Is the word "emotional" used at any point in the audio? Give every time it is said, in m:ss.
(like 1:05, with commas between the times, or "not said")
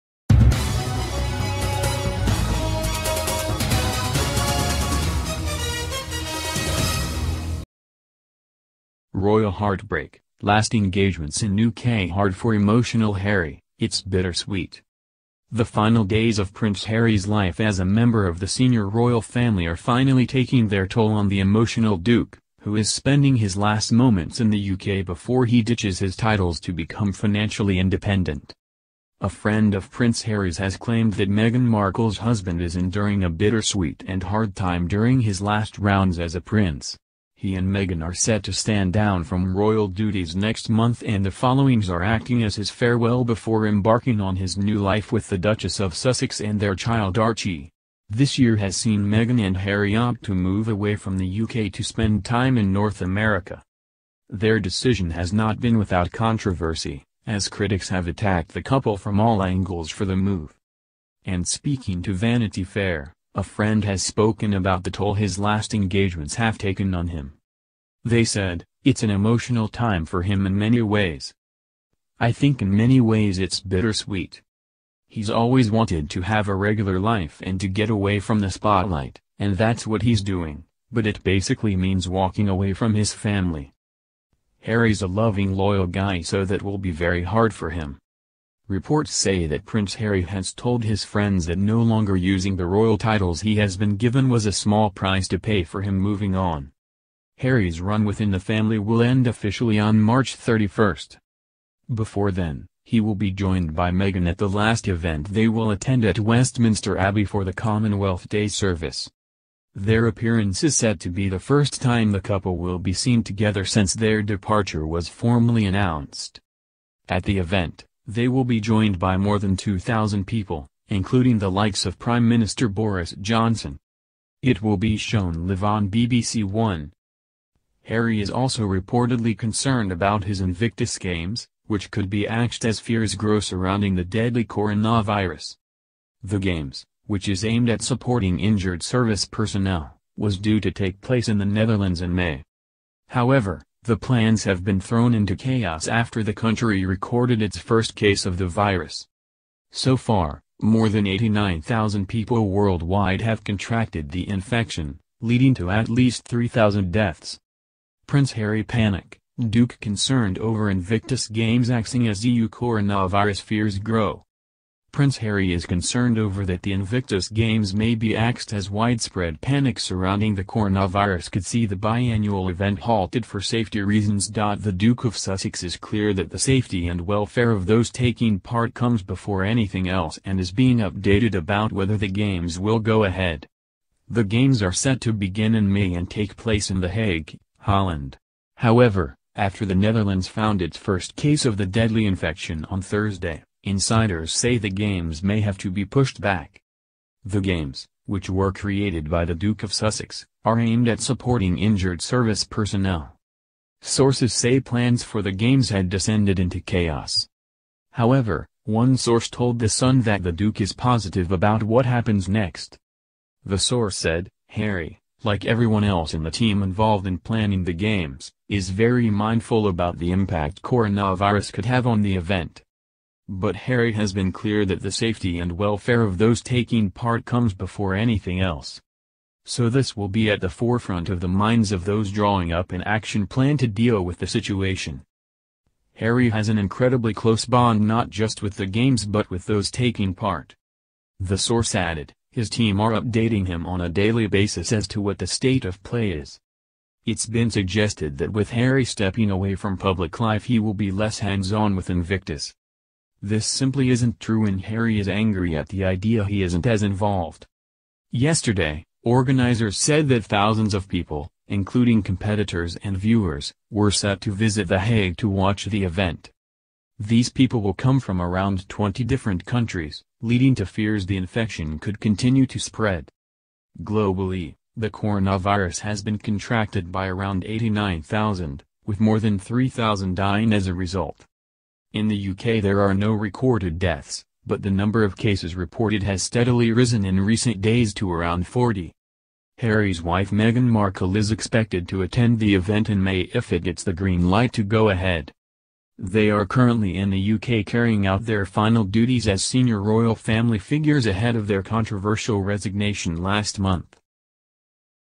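0:12, 0:21, 1:09.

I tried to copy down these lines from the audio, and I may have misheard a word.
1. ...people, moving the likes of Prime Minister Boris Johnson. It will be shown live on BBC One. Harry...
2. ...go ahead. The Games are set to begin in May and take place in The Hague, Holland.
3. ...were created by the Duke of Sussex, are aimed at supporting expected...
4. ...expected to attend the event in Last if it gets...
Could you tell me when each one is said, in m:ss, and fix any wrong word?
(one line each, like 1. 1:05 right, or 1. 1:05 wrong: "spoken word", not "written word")
1. 2:00 wrong: "including", not "moving"
2. 3:02 right
3. 3:18 wrong: "injured", not "expected"
4. 4:51 wrong: "May", not "Last".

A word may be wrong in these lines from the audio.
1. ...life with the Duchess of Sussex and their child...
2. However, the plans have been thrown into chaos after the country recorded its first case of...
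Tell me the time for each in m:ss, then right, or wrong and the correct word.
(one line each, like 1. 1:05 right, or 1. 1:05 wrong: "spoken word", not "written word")
1. 0:44 right
2. 2:23 right.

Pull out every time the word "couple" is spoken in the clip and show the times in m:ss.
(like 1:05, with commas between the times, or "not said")
0:58, 1:52.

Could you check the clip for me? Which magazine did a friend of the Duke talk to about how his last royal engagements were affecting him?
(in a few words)
Vanity Fair.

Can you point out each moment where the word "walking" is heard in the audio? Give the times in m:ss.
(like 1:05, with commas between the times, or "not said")
1:22.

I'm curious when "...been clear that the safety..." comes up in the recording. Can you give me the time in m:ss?
3:44.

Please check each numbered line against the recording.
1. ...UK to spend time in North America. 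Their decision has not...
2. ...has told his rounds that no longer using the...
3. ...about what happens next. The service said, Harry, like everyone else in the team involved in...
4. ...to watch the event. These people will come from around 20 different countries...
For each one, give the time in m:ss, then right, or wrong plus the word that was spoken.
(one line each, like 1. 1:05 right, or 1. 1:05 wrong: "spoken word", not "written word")
1. 0:51 right
2. 1:30 wrong: "friends", not "rounds"
3. 3:31 wrong: "source", not "service"
4. 4:25 right.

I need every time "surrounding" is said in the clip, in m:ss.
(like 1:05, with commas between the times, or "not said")
2:13, 2:49.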